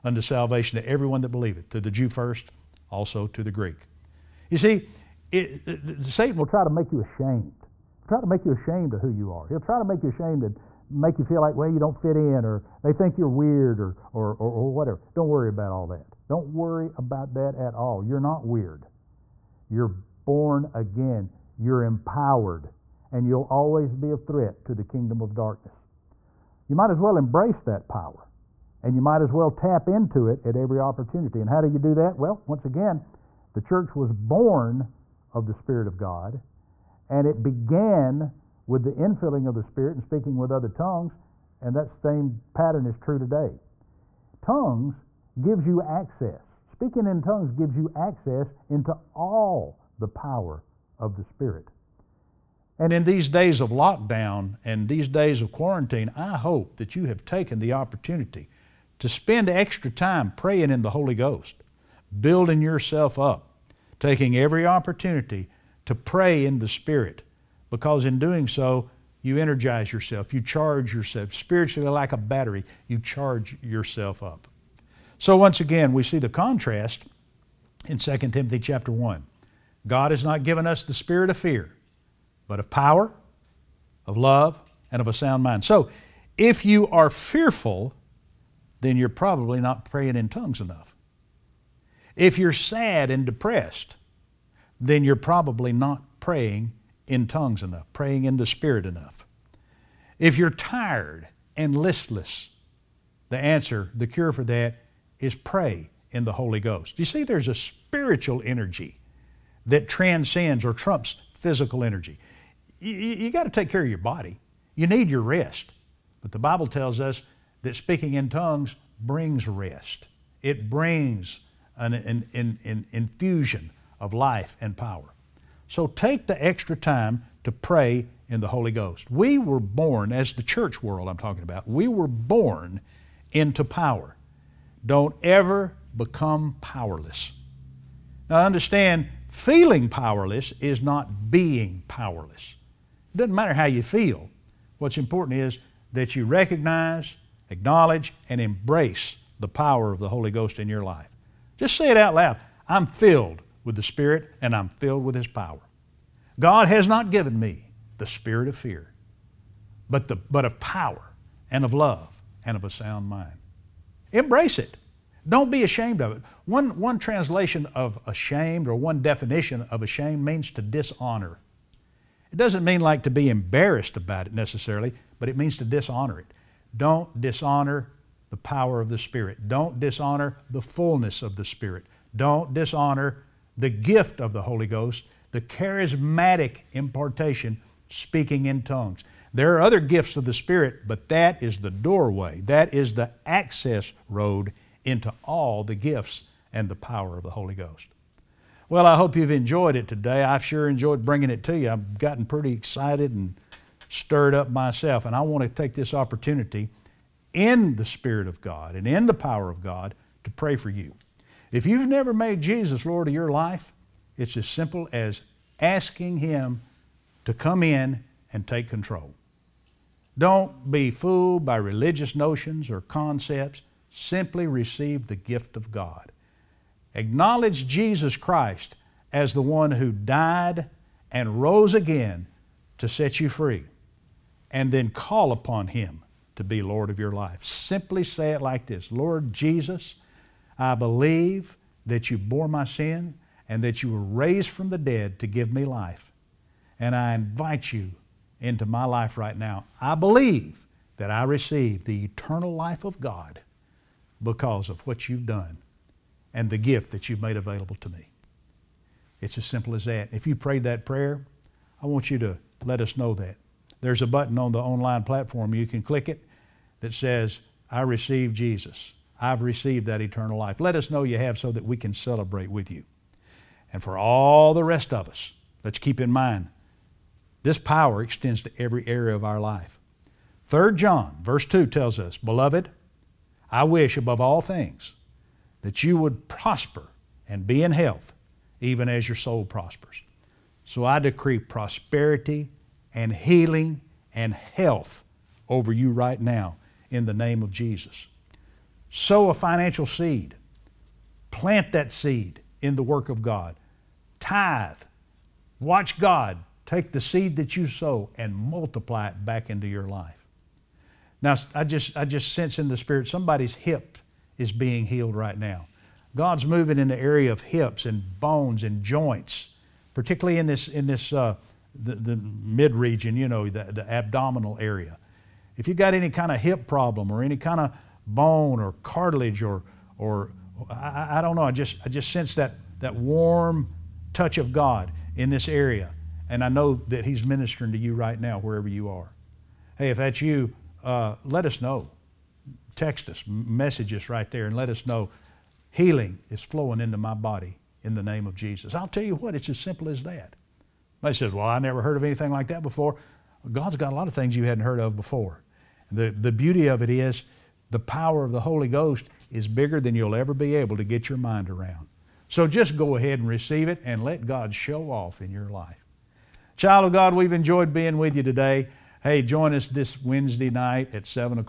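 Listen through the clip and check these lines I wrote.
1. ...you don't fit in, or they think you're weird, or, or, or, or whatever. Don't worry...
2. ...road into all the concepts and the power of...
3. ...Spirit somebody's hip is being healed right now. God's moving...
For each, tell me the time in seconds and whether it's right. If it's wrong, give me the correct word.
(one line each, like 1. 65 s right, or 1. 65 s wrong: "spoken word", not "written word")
1. 11 s right
2. 194 s wrong: "gifts", not "concepts"
3. 312 s right.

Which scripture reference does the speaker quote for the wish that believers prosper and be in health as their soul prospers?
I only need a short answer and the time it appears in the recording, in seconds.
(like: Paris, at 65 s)
3 John 2, at 280 s.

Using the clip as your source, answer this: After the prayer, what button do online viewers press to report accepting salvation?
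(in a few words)
I receive Jesus.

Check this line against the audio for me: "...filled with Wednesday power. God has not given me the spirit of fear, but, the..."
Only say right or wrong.
wrong.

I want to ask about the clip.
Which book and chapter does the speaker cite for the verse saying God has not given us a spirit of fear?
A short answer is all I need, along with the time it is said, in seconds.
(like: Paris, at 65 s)
2 Timothy chapter 1, at 77 s.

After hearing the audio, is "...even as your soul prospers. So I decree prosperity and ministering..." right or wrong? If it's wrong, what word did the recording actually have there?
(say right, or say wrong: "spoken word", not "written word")
wrong: "healing", not "ministering".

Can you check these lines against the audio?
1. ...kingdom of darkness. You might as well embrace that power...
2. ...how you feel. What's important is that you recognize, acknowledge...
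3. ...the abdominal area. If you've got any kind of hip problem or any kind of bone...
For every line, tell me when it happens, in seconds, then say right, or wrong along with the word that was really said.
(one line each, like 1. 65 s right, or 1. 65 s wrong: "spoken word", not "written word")
1. 24 s right
2. 143 s right
3. 323 s right.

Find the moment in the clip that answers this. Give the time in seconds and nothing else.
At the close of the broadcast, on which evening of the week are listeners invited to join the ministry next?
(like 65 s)
370 s.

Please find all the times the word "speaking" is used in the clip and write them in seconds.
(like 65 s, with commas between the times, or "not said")
40 s, 46 s, 117 s, 187 s.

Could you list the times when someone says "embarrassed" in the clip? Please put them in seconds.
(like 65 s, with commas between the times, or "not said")
173 s.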